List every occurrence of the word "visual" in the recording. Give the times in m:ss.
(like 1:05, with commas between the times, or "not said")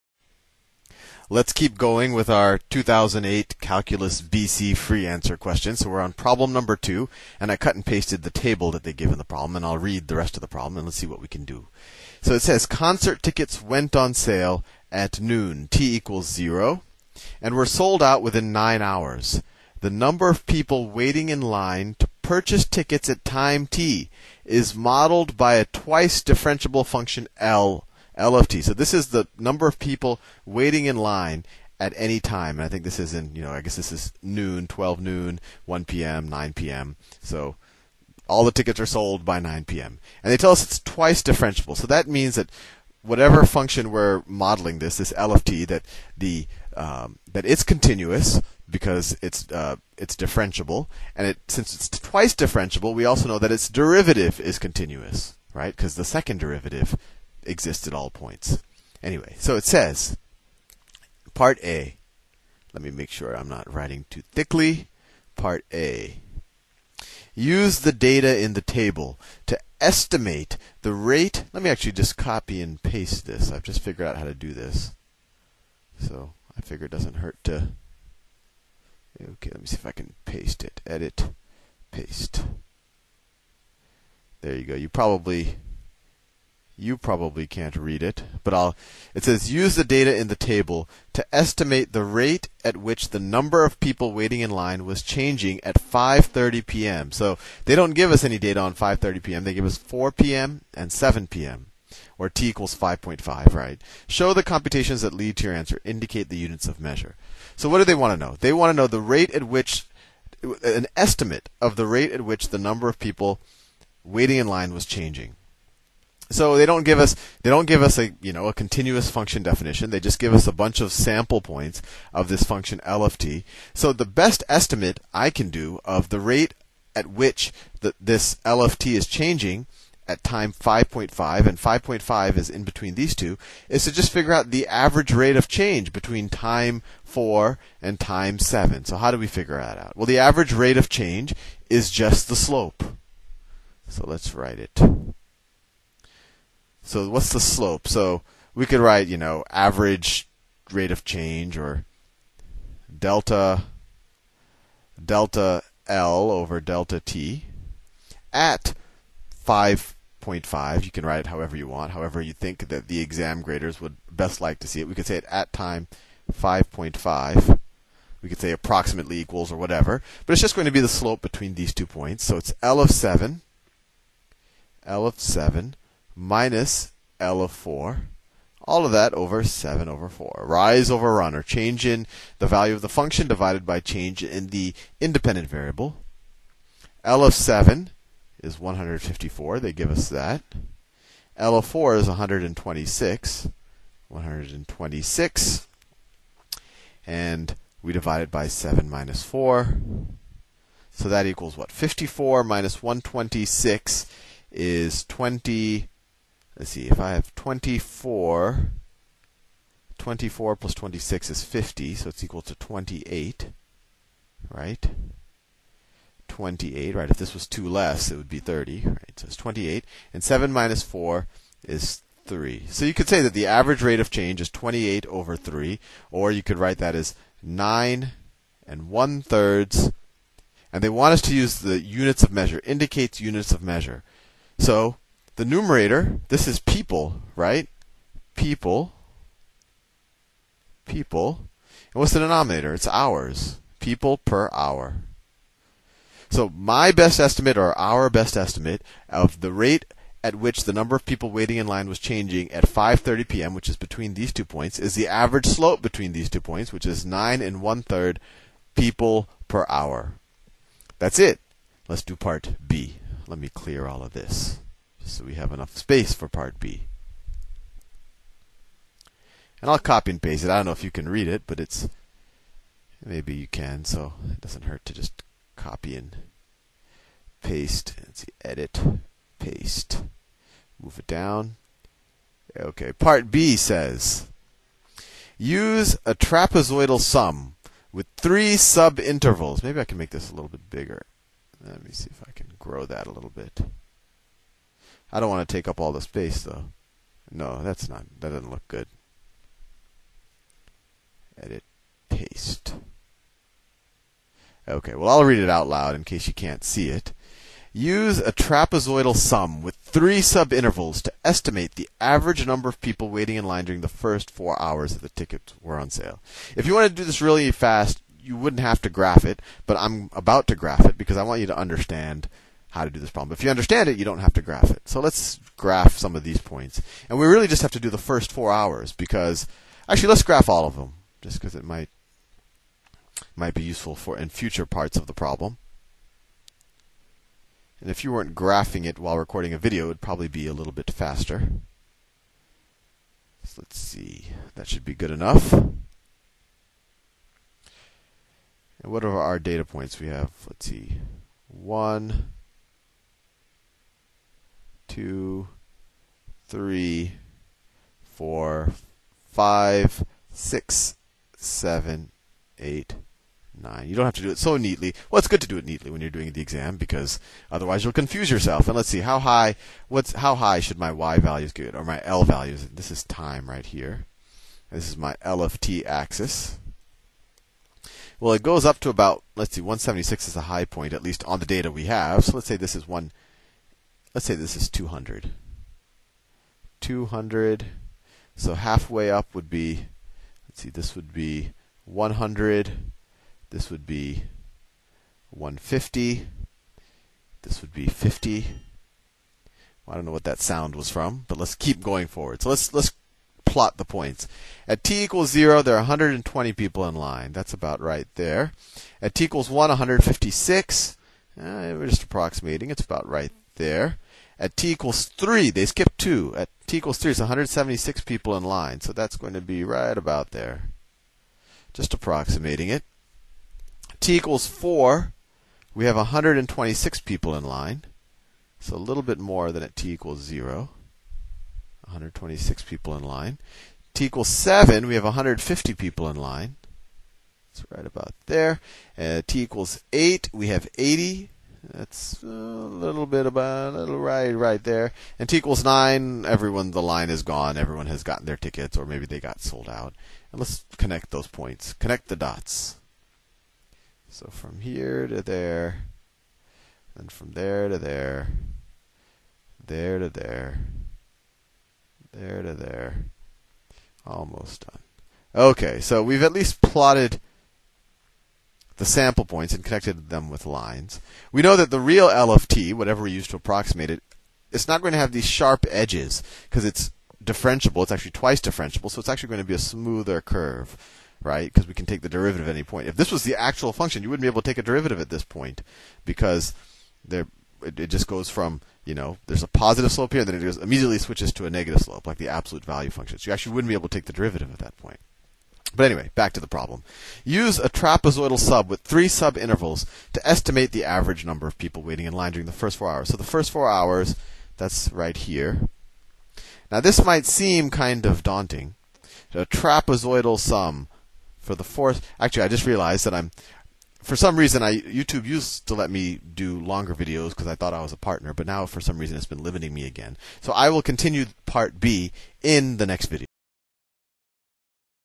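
not said.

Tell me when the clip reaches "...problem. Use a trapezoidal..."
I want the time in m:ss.
8:16.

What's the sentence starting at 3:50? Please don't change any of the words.
And they want us to use the units of measure, indicates units of measure.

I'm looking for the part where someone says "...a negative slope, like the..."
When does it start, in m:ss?
8:11.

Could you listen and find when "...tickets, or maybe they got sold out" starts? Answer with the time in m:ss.
7:28.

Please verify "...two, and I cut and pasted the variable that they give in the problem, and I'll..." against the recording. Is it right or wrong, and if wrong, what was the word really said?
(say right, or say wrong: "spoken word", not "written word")
wrong: "table", not "variable".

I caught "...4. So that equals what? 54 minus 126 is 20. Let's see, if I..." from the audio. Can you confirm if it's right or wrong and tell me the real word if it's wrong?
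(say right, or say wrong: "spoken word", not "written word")
right.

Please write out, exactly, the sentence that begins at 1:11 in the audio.
Let me actually just copy and paste this.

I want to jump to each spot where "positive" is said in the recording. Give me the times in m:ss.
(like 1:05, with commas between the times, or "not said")
8:09.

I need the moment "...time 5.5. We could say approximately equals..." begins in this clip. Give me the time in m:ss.
2:45.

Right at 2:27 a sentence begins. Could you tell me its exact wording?
So we could write, you know, average rate of change or delta delta L over delta T at 5.5.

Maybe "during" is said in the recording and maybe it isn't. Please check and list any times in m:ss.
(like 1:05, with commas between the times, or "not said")
5:13, 8:22.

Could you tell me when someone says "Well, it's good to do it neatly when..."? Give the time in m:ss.
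6:05.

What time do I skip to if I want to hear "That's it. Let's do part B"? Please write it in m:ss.
4:20.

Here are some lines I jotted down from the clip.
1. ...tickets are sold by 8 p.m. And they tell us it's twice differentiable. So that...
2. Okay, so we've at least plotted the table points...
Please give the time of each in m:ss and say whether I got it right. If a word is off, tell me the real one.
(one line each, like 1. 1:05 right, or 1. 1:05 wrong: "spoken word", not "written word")
1. 0:38 wrong: "9", not "8"
2. 7:45 wrong: "sample", not "table".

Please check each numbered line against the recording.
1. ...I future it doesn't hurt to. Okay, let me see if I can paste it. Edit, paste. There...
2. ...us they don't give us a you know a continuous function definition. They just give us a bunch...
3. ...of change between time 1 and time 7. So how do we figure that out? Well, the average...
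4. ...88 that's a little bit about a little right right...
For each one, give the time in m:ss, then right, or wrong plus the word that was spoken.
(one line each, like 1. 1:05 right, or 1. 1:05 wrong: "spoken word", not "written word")
1. 1:16 wrong: "figure", not "future"
2. 1:56 right
3. 2:15 wrong: "4", not "1"
4. 7:20 wrong: "80", not "88".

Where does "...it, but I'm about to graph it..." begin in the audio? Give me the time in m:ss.
5:19.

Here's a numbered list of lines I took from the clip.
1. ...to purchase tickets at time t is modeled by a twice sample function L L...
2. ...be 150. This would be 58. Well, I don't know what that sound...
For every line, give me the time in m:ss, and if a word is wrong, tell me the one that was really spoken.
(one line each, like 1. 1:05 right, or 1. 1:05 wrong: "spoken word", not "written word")
1. 0:21 wrong: "differentiable", not "sample"
2. 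6:33 wrong: "50", not "58".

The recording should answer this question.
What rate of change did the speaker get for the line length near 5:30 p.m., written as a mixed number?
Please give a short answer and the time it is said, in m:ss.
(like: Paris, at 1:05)
9 1/3, at 4:17.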